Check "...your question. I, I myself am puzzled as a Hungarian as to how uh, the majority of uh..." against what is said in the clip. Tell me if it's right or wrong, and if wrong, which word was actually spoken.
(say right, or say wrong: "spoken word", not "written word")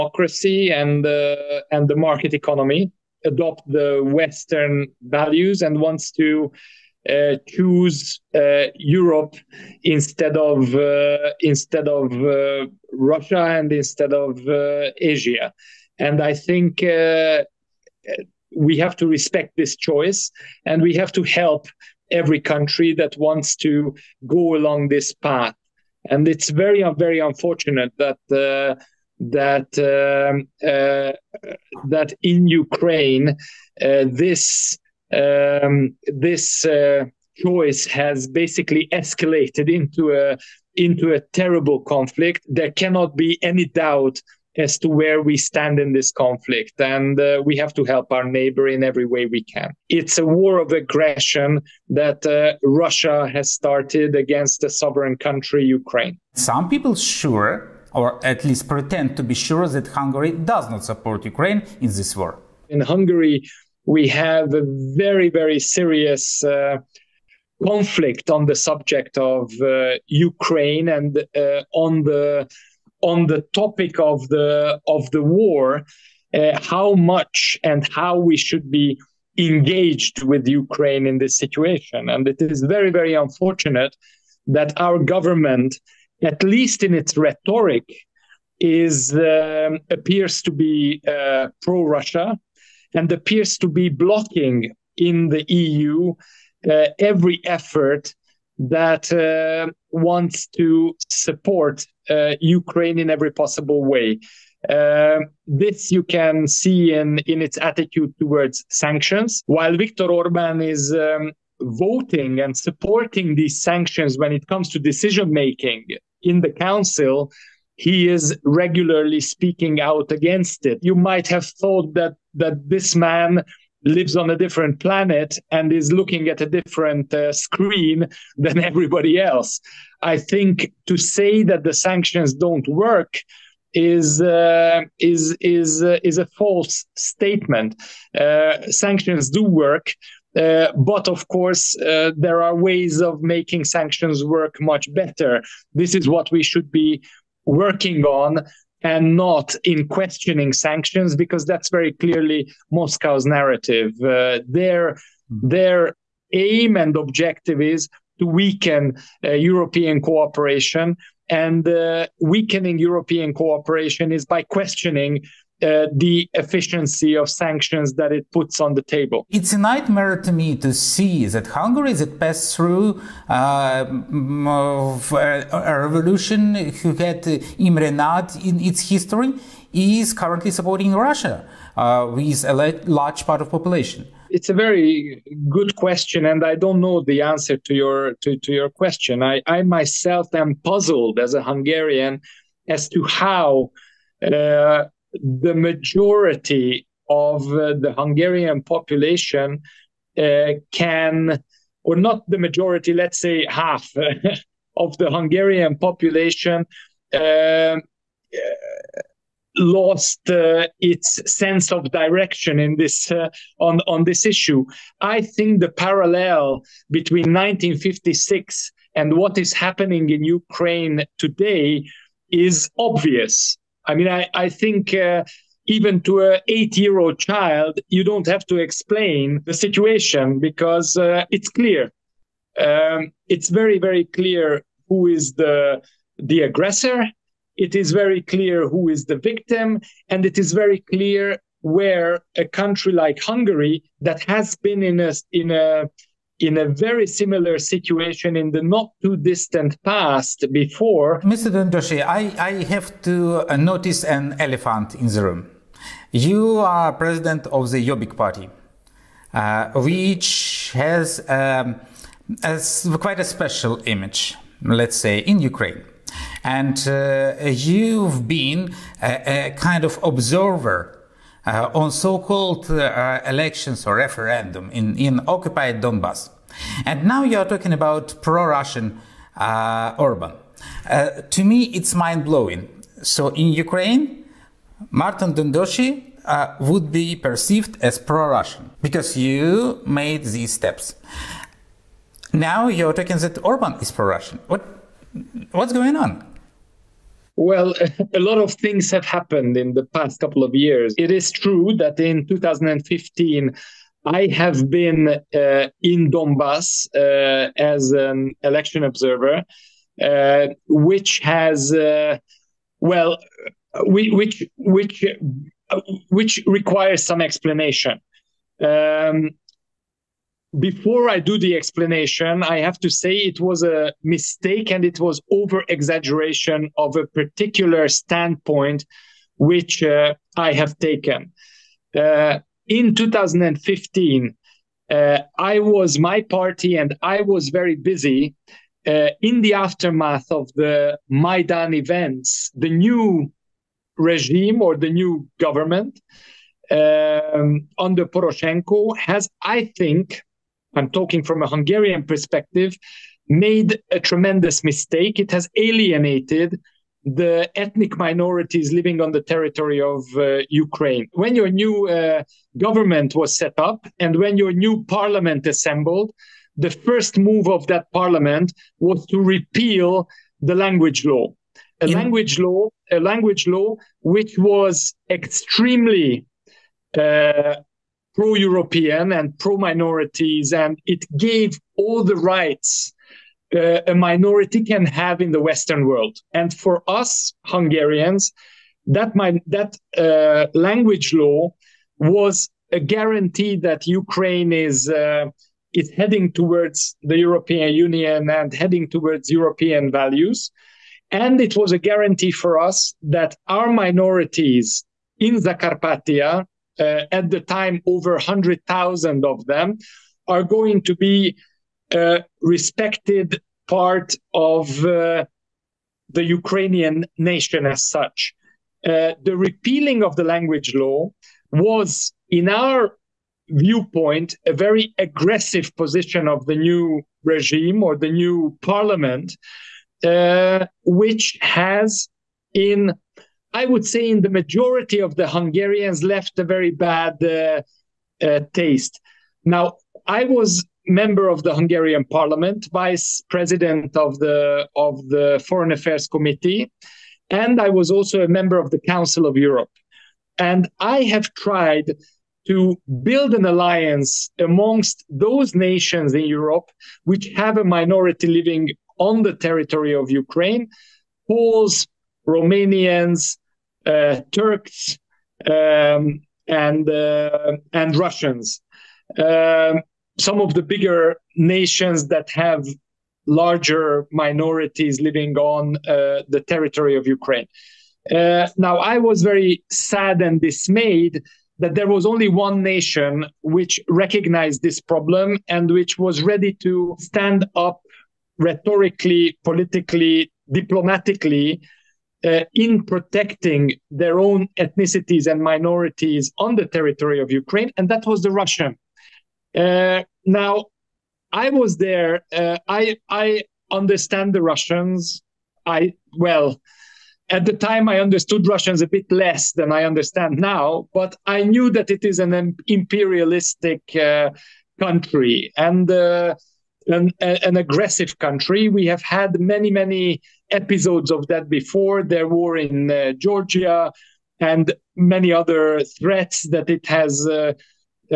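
right.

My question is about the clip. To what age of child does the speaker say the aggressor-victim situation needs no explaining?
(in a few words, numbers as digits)
8.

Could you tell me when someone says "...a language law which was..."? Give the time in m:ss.
6:12.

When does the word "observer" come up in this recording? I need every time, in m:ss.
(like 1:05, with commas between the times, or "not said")
4:30, 5:08.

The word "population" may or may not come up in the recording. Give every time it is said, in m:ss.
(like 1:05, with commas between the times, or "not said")
3:03, 3:18, 3:25.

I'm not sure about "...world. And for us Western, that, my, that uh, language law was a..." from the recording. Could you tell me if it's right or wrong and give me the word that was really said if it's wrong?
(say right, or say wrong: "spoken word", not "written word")
wrong: "Hungarians", not "Western".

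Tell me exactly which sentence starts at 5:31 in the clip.
Uh, in 2015, uh, I was my party and I was very busy.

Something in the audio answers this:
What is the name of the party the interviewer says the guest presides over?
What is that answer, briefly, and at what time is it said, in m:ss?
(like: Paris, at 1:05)
Jobbik, at 4:17.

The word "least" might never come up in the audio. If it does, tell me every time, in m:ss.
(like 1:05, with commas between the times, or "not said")
0:58, 1:26.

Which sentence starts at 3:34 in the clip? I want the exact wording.
I think the parallel between 1956 and what is happening in Ukraine today is obvious.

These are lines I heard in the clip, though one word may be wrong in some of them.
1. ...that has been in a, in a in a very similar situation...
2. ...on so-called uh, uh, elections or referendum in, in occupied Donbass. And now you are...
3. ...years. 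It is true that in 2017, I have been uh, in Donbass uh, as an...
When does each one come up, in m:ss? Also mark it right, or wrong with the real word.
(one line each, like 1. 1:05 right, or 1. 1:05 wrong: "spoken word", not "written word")
1. 4:04 right
2. 4:31 right
3. 5:00 wrong: "2015", not "2017".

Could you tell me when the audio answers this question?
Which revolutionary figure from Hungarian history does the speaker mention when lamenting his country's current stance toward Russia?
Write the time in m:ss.
2:57.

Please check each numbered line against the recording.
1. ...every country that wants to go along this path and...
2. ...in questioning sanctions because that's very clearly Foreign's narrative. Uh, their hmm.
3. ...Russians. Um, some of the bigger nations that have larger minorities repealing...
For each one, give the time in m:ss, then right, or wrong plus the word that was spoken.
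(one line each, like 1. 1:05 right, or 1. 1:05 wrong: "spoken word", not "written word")
1. 0:22 right
2. 2:29 wrong: "Moscow", not "Foreign"
3. 7:47 wrong: "living", not "repealing".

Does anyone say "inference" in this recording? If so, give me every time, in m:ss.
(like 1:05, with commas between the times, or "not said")
not said.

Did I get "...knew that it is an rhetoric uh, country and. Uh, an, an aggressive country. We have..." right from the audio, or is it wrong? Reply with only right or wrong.
wrong.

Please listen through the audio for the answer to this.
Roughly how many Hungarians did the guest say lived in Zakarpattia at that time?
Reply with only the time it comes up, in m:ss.
6:47.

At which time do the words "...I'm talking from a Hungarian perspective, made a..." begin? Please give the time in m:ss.
5:50.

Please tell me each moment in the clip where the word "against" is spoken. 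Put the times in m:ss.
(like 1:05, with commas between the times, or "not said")
0:54, 2:00.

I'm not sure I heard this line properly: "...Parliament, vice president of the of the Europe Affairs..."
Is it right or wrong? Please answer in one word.
wrong.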